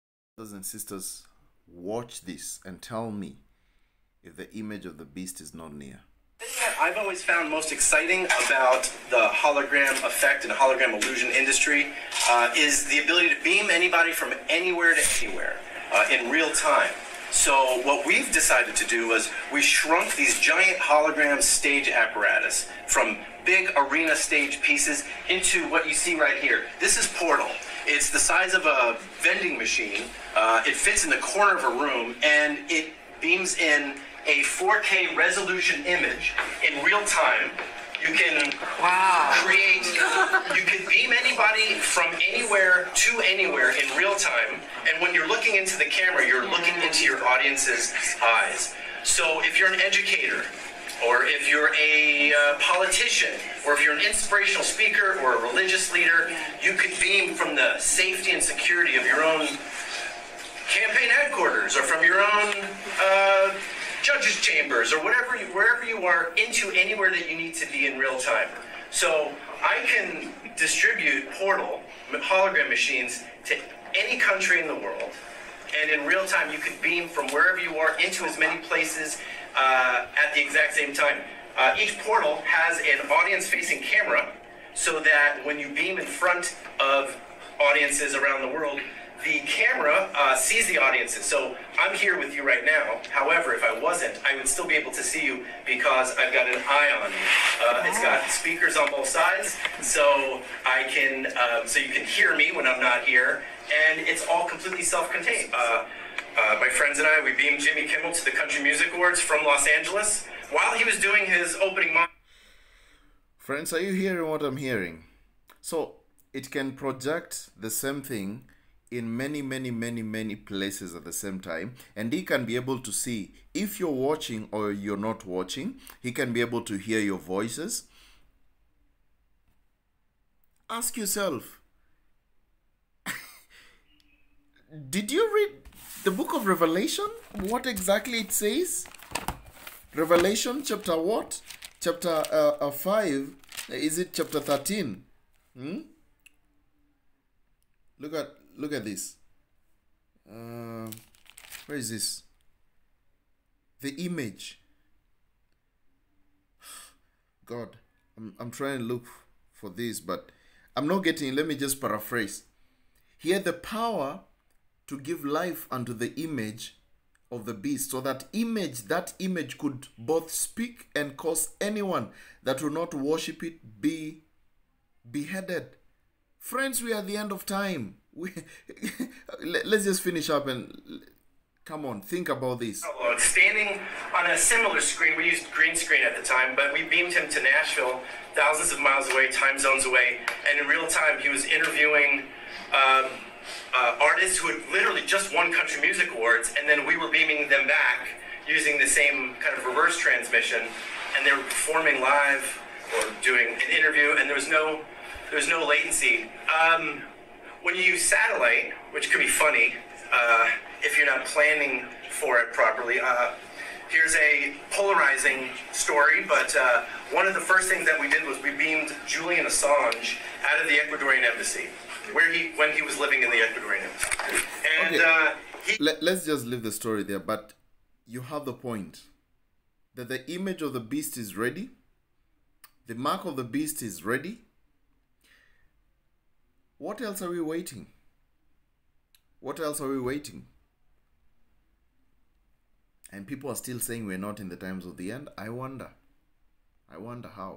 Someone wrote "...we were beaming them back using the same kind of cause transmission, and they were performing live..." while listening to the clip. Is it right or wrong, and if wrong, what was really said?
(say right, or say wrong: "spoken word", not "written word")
wrong: "reverse", not "cause".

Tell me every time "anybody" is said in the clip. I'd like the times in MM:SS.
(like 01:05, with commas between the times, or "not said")
00:13, 00:41.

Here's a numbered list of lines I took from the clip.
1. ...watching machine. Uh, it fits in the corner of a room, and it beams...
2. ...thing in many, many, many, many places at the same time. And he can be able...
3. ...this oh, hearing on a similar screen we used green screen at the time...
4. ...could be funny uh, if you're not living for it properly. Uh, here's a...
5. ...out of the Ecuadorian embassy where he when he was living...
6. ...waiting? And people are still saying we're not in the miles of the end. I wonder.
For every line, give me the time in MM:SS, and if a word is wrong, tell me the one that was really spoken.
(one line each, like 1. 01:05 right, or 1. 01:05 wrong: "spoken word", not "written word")
1. 00:29 wrong: "vending", not "watching"
2. 01:58 right
3. 03:02 wrong: "standing", not "hearing"
4. 03:29 wrong: "planning", not "living"
5. 03:40 right
6. 04:00 wrong: "times", not "miles".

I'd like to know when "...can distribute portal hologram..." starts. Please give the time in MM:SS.
01:09.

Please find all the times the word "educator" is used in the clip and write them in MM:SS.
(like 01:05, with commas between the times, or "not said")
00:49.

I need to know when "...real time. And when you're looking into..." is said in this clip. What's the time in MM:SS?
00:43.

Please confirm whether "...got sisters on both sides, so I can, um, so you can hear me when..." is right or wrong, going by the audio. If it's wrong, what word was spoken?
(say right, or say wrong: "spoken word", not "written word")
wrong: "speakers", not "sisters".